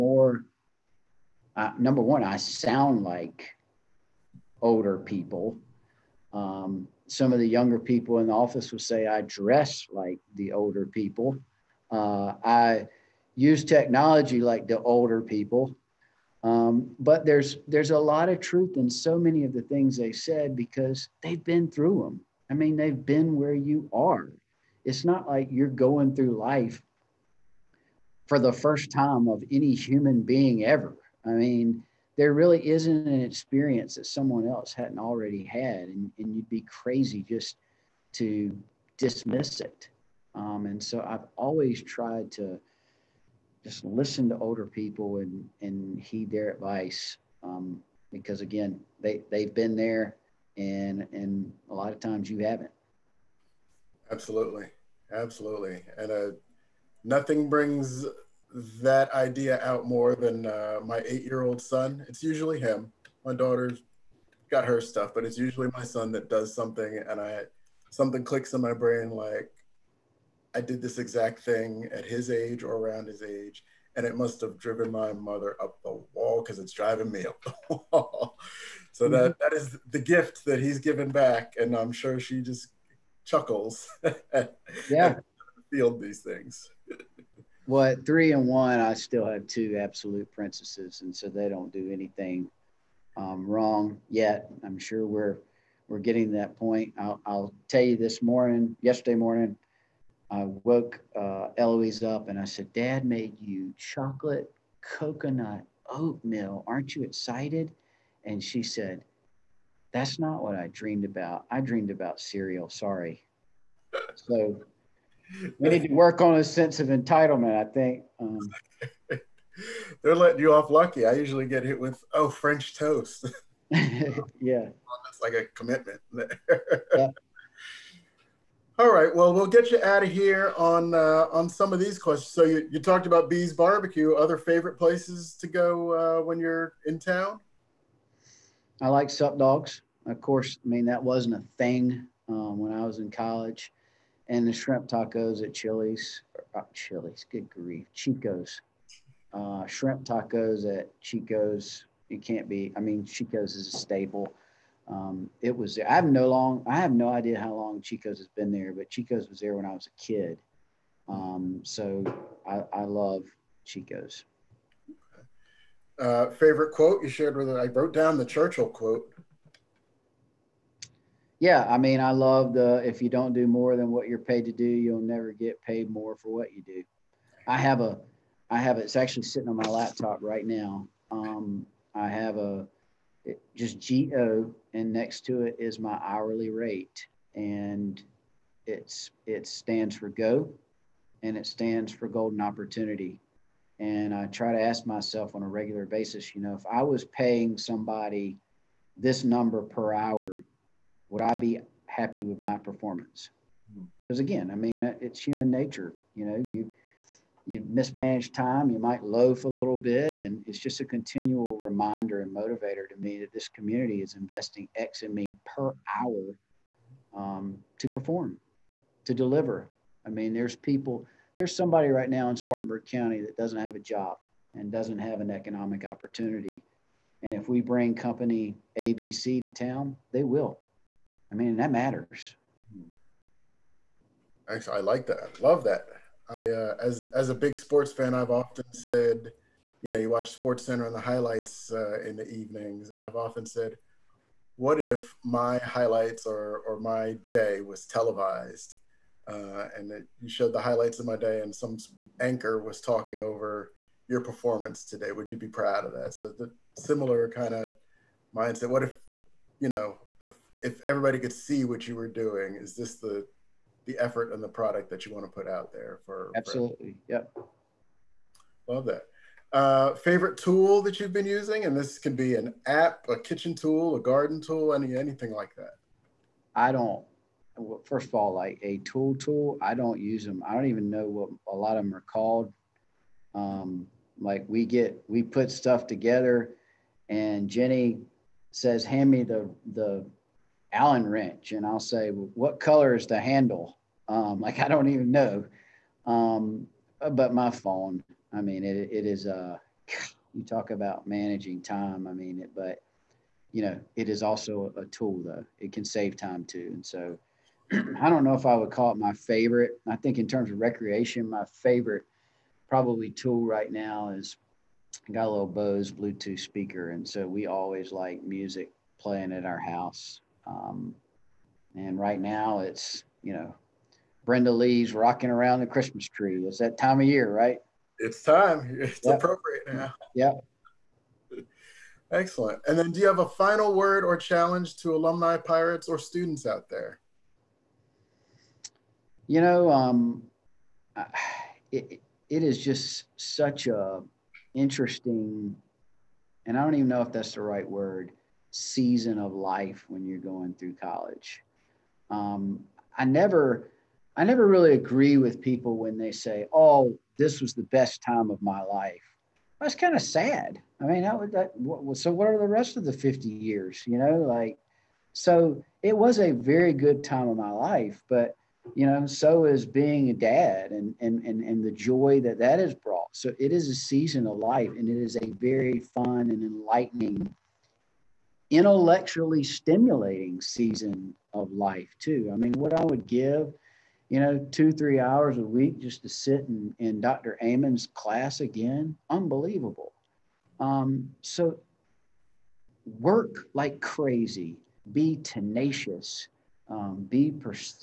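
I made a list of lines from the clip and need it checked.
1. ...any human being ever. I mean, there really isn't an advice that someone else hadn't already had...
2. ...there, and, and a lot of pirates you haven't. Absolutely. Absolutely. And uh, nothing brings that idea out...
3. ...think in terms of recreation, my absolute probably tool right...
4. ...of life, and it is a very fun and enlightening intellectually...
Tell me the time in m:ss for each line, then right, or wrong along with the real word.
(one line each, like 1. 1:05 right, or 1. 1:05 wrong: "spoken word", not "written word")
1. 0:29 wrong: "experience", not "advice"
2. 0:49 wrong: "times", not "pirates"
3. 5:09 wrong: "favorite", not "absolute"
4. 6:14 right.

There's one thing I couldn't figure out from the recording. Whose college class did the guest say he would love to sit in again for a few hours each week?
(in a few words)
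Dr. Eamon.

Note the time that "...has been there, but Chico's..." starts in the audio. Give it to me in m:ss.
2:38.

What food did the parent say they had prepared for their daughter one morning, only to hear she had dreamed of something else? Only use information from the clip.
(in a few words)
chocolate coconut oatmeal.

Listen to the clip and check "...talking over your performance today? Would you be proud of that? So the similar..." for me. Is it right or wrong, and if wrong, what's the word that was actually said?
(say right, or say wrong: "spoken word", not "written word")
right.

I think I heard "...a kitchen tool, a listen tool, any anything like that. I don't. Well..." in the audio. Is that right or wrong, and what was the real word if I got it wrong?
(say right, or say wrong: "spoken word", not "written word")
wrong: "garden", not "listen".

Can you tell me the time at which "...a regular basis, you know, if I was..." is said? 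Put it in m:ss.
3:15.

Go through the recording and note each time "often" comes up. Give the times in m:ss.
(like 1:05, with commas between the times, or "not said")
3:58, 4:03.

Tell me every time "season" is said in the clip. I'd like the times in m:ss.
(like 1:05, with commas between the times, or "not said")
5:48, 6:13, 6:20.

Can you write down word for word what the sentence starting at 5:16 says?
And so we always like music playing at our house.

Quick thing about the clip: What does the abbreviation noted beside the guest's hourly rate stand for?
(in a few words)
Golden Opportunity.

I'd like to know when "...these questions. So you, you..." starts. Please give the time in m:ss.
2:11.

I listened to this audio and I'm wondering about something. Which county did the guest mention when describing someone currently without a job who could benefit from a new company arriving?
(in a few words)
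Spartanburg County.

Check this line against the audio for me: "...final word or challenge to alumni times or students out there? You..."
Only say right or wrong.
wrong.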